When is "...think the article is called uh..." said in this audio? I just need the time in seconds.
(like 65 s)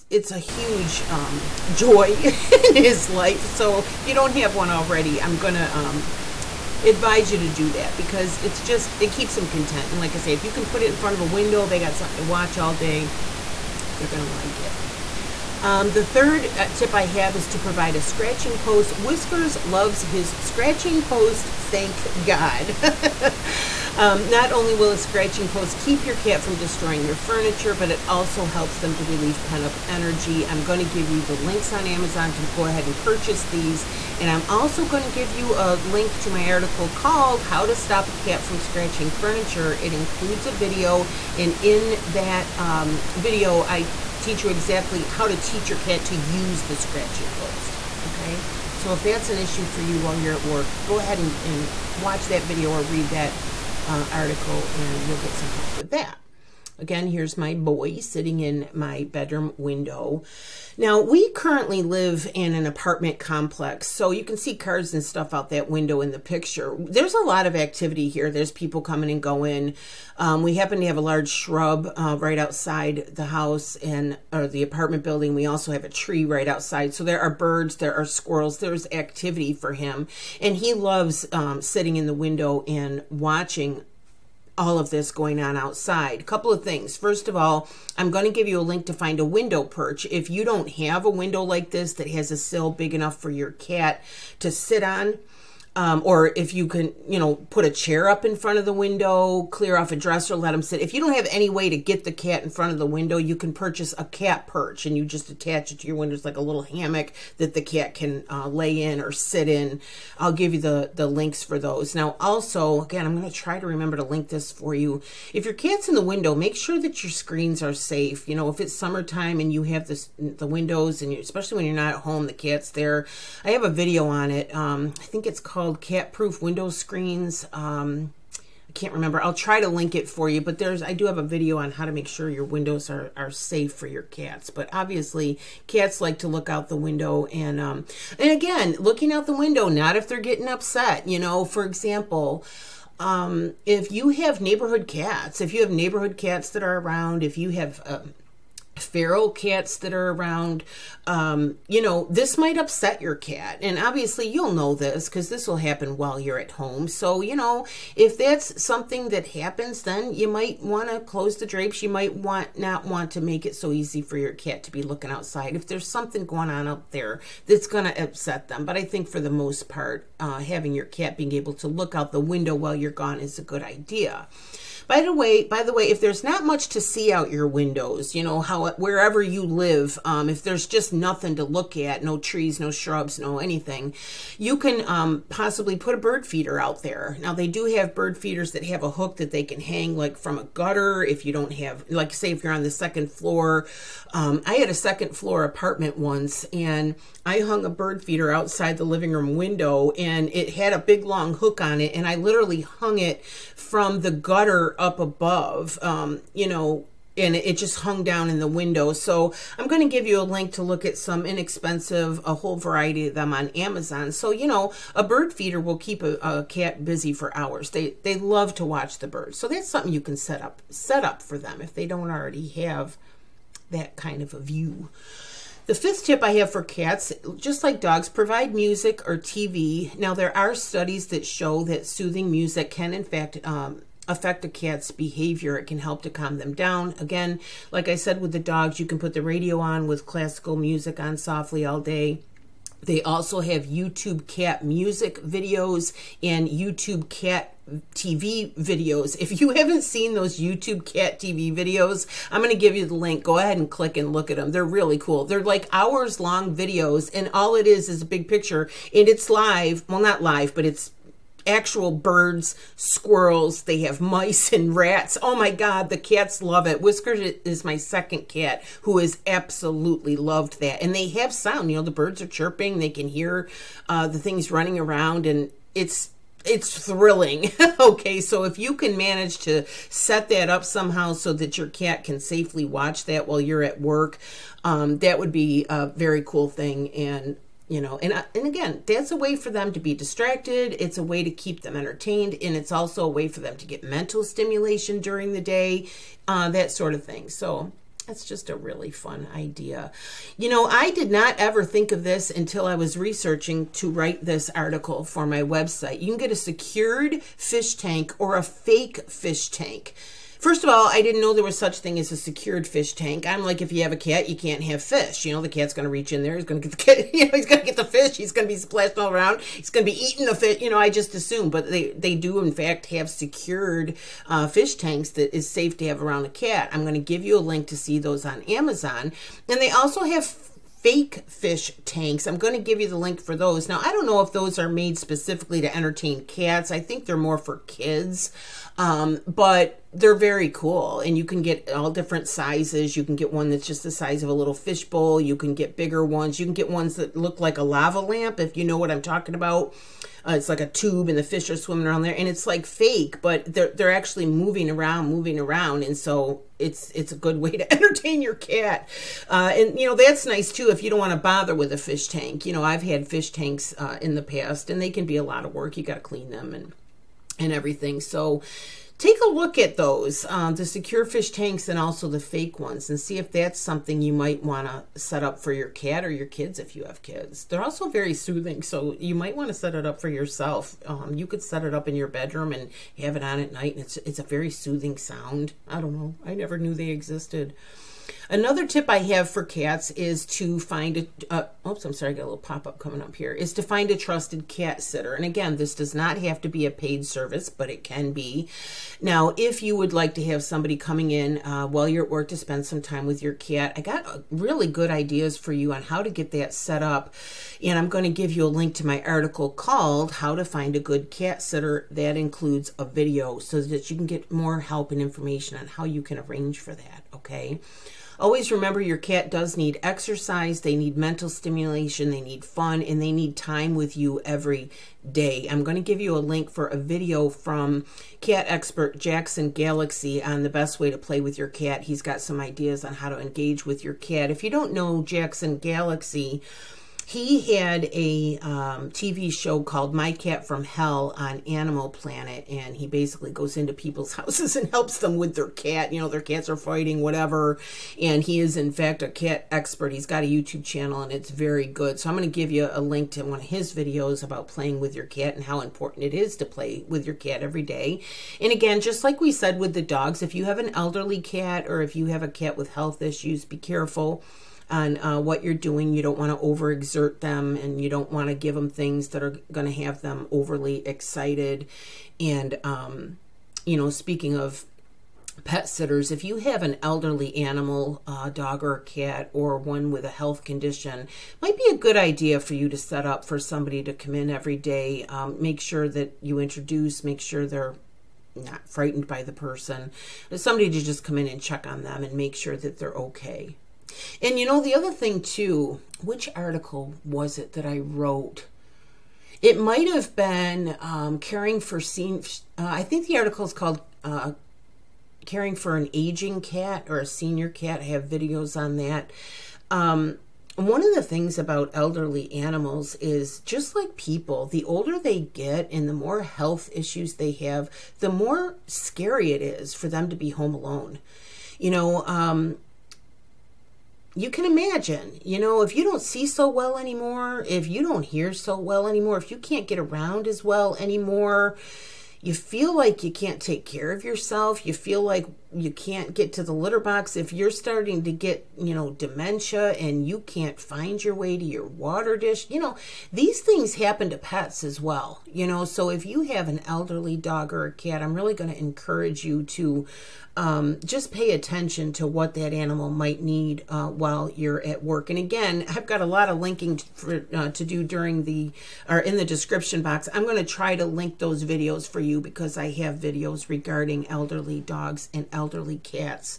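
502 s.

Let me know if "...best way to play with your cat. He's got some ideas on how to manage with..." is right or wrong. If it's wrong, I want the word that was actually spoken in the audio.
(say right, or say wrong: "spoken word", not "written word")
wrong: "engage", not "manage".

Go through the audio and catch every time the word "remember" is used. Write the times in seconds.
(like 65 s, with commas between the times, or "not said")
113 s, 128 s, 418 s.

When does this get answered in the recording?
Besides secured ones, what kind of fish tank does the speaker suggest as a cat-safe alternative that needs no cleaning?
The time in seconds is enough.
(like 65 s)
308 s.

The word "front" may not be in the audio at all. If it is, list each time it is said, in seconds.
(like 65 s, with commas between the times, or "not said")
10 s, 98 s, 102 s.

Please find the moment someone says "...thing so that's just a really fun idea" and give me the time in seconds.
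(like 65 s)
297 s.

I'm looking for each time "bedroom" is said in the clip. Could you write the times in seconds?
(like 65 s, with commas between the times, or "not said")
59 s, 382 s.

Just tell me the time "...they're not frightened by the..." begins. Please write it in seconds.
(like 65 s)
487 s.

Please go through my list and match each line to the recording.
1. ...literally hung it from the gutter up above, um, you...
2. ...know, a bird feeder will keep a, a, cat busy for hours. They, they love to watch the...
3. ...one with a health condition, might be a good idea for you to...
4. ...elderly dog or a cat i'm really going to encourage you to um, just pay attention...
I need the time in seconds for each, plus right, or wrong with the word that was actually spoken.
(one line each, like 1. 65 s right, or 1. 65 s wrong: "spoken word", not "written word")
1. 202 s right
2. 214 s right
3. 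479 s right
4. 546 s right.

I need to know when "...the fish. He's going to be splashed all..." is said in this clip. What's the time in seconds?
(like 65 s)
317 s.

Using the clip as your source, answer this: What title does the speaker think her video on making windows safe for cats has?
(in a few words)
Cat Proof Window Screens.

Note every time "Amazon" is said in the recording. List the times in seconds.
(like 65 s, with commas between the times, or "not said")
31 s, 213 s, 328 s.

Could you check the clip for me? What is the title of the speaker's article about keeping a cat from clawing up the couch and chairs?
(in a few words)
How to Stop a Cat from Scratching Furniture.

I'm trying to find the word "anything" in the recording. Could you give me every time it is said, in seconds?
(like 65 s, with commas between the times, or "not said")
183 s.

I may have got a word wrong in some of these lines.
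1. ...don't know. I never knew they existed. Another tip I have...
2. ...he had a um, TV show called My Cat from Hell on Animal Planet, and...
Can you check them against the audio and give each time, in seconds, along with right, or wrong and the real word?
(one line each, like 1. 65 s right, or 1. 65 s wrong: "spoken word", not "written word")
1. 385 s right
2. 437 s right.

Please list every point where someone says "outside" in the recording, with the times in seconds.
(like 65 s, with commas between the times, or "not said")
72 s, 76 s, 85 s, 165 s, 198 s.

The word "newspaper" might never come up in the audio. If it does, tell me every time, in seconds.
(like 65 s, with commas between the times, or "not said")
not said.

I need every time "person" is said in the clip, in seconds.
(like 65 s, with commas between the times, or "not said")
489 s.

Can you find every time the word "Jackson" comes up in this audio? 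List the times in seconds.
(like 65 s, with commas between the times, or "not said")
428 s, 435 s.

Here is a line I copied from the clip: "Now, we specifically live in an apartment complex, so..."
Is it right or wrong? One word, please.
wrong.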